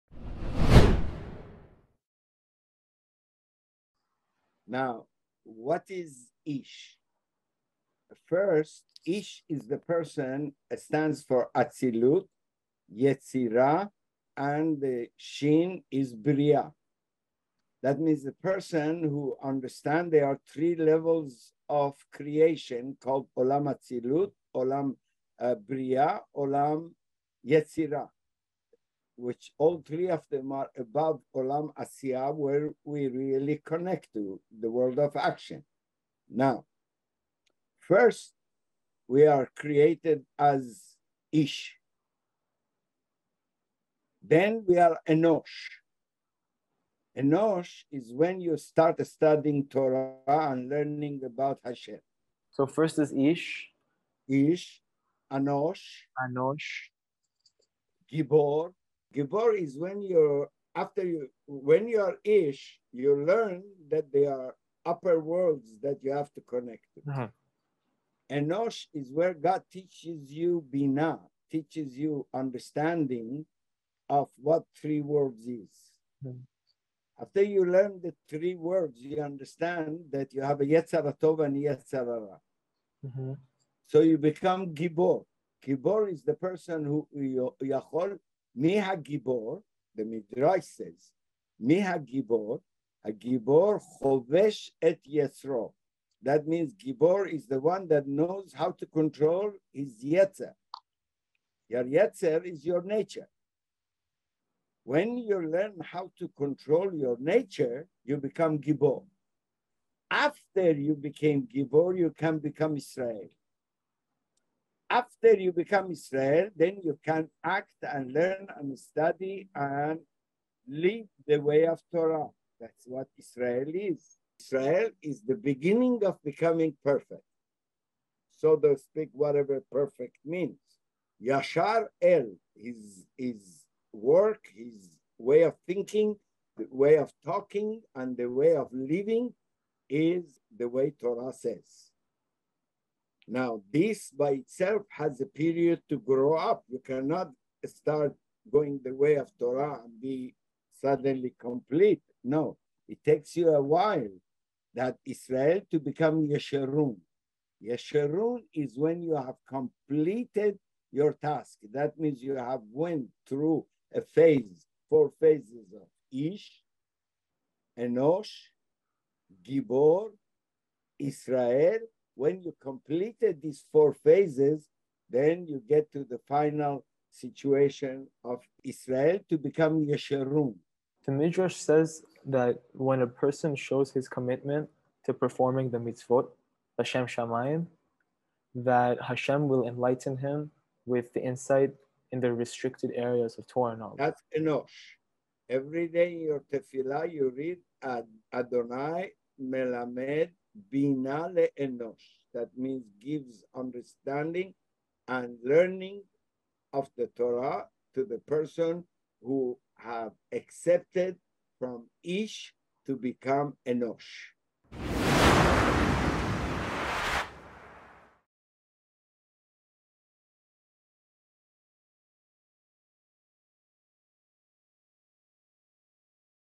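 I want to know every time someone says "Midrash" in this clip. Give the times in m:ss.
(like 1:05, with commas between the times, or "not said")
1:30, 3:01.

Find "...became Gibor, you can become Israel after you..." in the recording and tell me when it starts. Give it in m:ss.
1:50.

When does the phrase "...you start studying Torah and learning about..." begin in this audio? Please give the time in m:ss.
0:48.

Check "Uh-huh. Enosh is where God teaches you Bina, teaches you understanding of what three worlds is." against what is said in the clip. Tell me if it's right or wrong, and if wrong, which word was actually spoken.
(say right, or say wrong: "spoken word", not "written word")
right.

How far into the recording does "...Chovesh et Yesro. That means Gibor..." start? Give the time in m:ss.
1:34.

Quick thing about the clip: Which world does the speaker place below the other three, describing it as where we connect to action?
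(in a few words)
Olam Asiya.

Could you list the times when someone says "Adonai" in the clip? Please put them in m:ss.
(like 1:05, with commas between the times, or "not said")
3:18.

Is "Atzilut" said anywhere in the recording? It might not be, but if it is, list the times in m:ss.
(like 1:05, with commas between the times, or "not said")
0:11, 0:23.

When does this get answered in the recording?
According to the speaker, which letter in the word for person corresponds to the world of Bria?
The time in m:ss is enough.
0:15.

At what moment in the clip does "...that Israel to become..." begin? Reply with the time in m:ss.
2:34.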